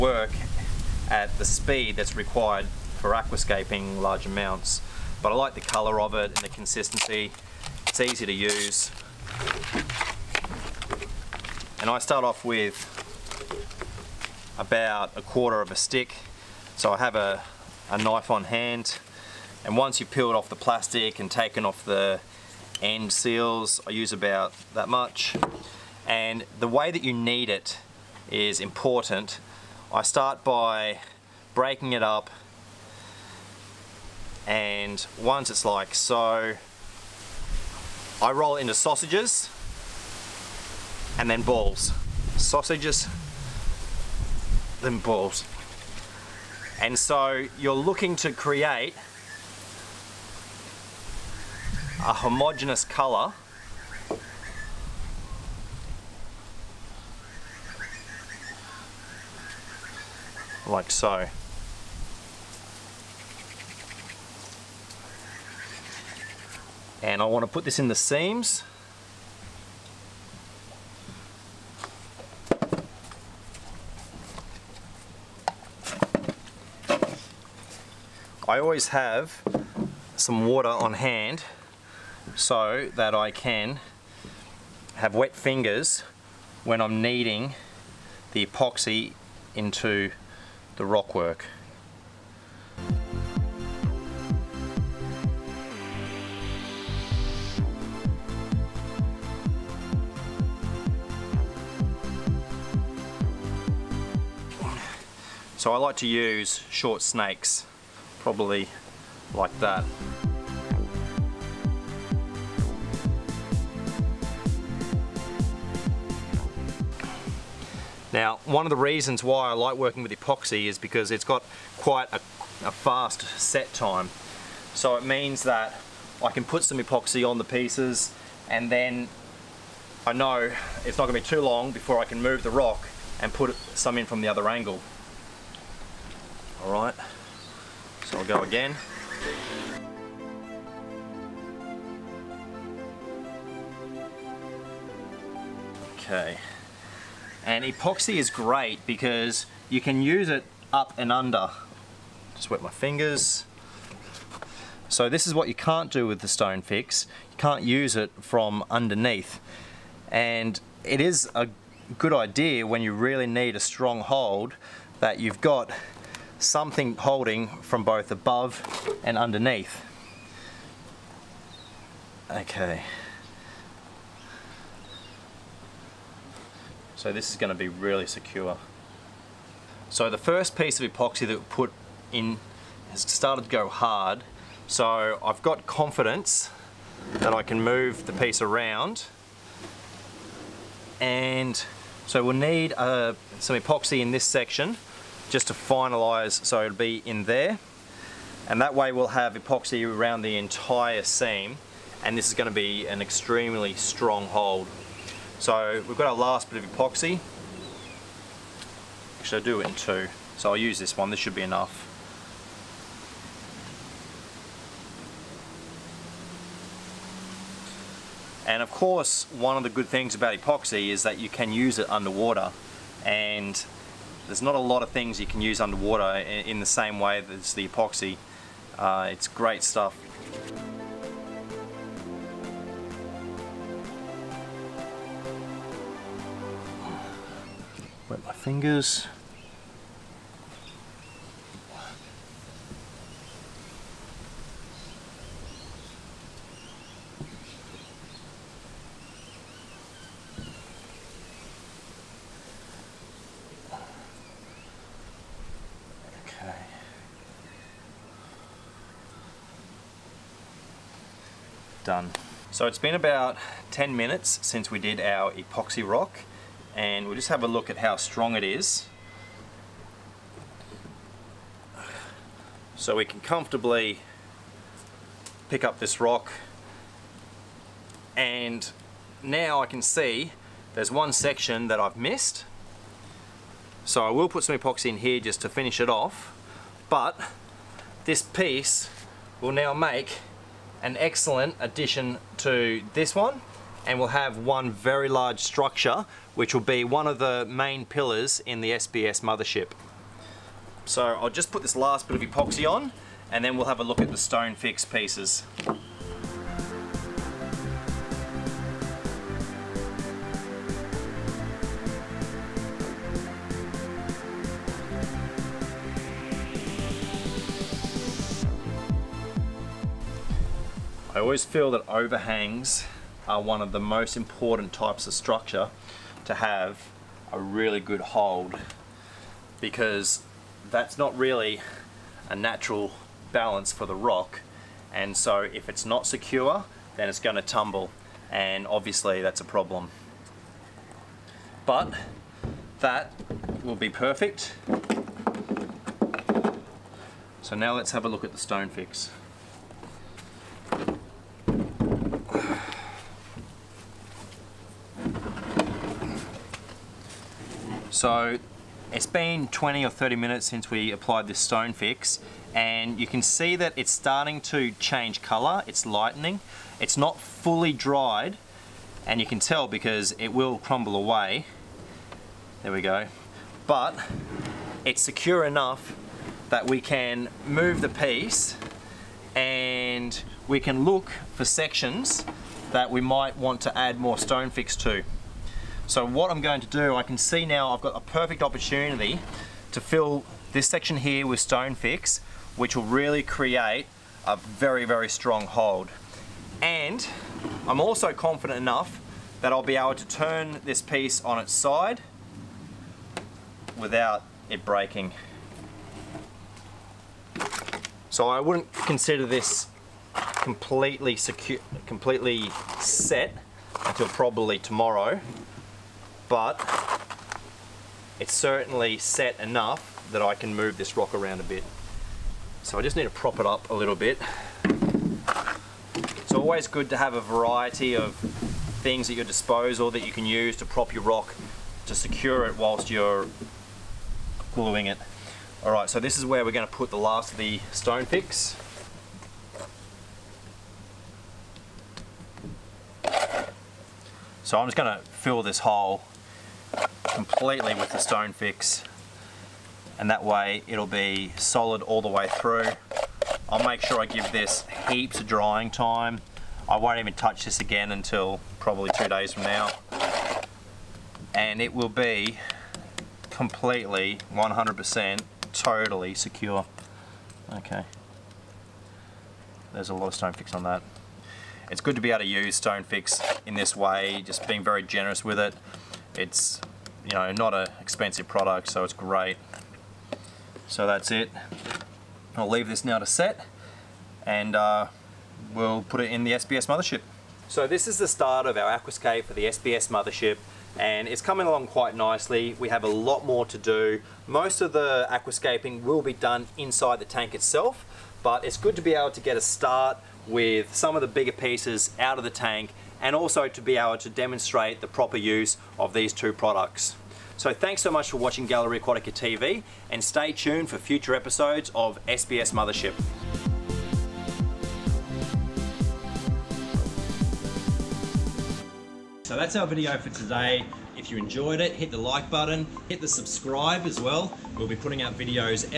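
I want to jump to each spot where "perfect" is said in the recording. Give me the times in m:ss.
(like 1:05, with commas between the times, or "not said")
5:43, 6:28.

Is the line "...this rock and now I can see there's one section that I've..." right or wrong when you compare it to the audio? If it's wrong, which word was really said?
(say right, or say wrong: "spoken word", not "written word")
right.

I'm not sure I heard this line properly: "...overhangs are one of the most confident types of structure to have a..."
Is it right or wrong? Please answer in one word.
wrong.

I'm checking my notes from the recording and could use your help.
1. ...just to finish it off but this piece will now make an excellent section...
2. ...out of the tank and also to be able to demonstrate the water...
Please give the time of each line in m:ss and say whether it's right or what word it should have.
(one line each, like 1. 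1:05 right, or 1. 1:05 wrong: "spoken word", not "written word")
1. 4:45 wrong: "addition", not "section"
2. 8:21 wrong: "proper", not "water".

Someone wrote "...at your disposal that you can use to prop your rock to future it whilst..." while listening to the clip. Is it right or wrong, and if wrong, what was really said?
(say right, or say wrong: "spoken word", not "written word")
wrong: "secure", not "future".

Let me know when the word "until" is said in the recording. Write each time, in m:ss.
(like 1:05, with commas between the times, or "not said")
6:53, 7:37.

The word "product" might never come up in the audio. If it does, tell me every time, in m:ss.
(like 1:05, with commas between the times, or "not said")
7:58, 8:26.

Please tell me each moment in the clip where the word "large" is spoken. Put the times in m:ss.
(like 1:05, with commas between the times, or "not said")
0:04, 4:55.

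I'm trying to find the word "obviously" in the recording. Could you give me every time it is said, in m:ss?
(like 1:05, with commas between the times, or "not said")
5:38.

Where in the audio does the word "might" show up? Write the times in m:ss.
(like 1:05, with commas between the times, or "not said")
6:23.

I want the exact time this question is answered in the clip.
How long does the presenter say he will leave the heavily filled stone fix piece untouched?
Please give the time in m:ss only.
7:38.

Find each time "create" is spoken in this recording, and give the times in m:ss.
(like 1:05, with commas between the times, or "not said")
0:48, 6:33.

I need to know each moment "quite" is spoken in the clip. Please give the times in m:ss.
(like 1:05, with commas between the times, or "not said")
2:01, 8:11.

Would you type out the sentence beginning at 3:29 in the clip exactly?
Actually I do it in two, so I'll use this one, this should be enough.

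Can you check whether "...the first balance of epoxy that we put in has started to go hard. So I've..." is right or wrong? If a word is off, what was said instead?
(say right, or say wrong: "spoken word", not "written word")
wrong: "piece", not "balance".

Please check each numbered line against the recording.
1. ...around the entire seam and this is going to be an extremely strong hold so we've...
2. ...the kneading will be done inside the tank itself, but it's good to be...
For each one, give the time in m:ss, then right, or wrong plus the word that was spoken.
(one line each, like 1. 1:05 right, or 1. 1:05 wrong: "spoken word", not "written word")
1. 3:19 right
2. 8:14 wrong: "aquascaping", not "kneading".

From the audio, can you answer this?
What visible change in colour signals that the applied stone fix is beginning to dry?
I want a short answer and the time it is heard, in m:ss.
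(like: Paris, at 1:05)
It's lightening, at 6:05.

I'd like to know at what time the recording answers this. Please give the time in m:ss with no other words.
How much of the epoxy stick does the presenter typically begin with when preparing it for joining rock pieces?
0:15.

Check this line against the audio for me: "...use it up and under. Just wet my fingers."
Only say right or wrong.
right.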